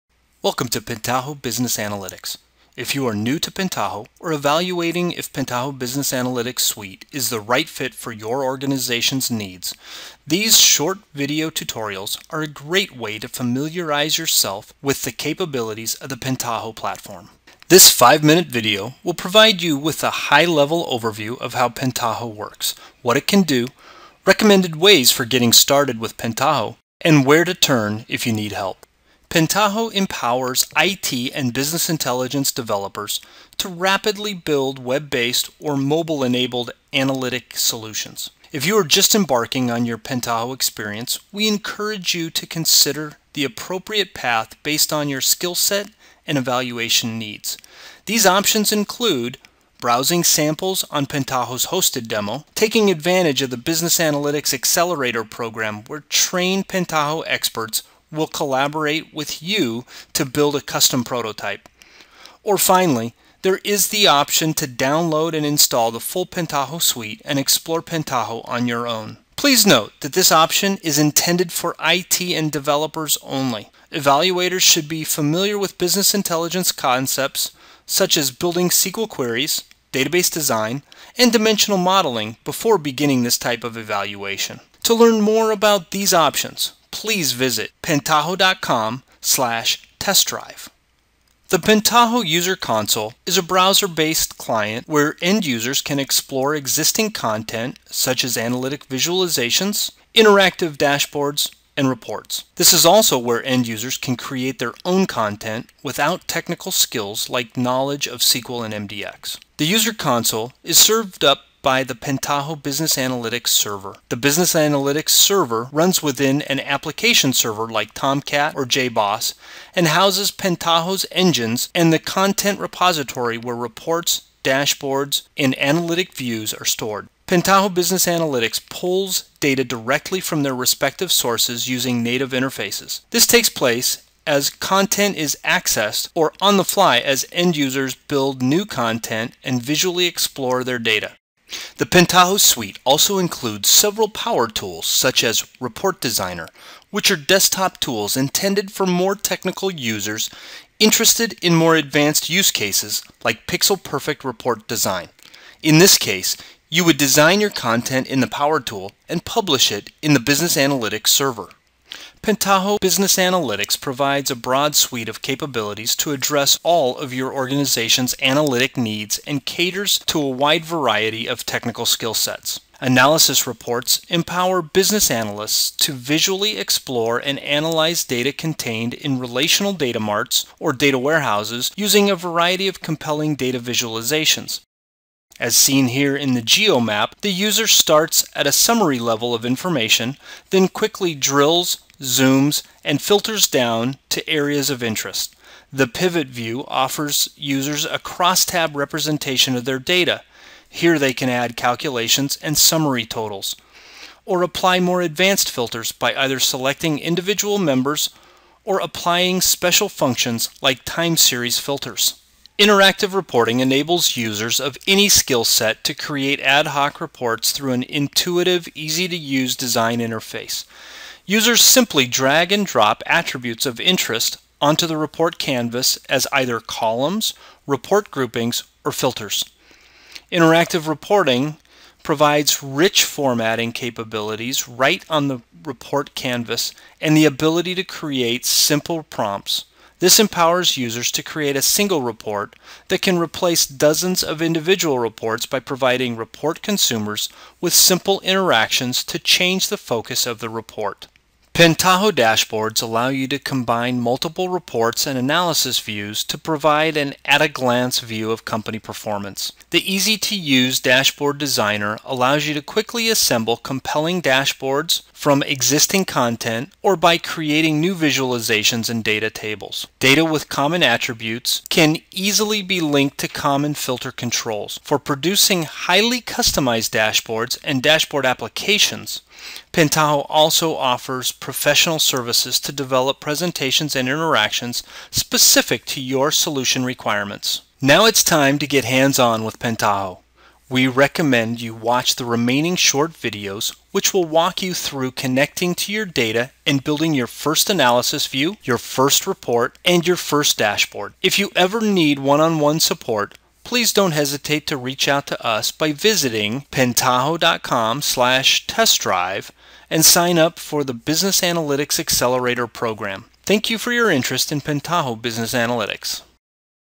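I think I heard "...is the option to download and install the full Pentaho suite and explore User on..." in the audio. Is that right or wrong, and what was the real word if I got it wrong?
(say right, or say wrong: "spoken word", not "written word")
wrong: "Pentaho", not "User".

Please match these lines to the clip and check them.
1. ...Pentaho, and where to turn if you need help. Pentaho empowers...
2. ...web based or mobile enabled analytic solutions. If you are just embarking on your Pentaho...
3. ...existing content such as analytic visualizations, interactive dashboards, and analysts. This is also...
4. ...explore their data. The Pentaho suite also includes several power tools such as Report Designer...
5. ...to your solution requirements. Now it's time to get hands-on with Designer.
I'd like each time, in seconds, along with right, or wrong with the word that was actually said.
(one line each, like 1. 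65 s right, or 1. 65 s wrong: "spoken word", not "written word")
1. 26 s right
2. 34 s right
3. 96 s wrong: "reports", not "analysts"
4. 140 s right
5. 285 s wrong: "Pentaho", not "Designer".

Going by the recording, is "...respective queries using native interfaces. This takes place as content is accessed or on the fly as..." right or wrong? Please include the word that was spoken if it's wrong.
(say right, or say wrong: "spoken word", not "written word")
wrong: "sources", not "queries".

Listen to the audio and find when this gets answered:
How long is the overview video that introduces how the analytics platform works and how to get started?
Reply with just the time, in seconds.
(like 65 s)
17 s.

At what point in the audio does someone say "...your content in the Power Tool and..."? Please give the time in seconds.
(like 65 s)
157 s.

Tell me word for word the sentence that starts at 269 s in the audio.
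Data with common attributes can easily be linked to common filter controls for producing highly customized dashboards and dashboard applications.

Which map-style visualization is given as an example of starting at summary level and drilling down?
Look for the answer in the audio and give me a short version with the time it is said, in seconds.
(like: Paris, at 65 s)
geomap, at 186 s.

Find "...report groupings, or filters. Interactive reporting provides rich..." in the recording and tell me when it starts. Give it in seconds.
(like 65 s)
227 s.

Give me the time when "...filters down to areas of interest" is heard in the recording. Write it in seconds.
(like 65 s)
193 s.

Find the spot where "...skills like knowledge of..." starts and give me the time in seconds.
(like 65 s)
106 s.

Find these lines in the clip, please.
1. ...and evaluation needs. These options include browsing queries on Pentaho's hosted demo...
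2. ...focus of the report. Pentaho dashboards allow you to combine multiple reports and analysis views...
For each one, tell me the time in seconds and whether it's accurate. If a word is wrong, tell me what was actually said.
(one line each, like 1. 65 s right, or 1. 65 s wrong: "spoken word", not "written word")
1. 46 s wrong: "samples", not "queries"
2. 249 s right.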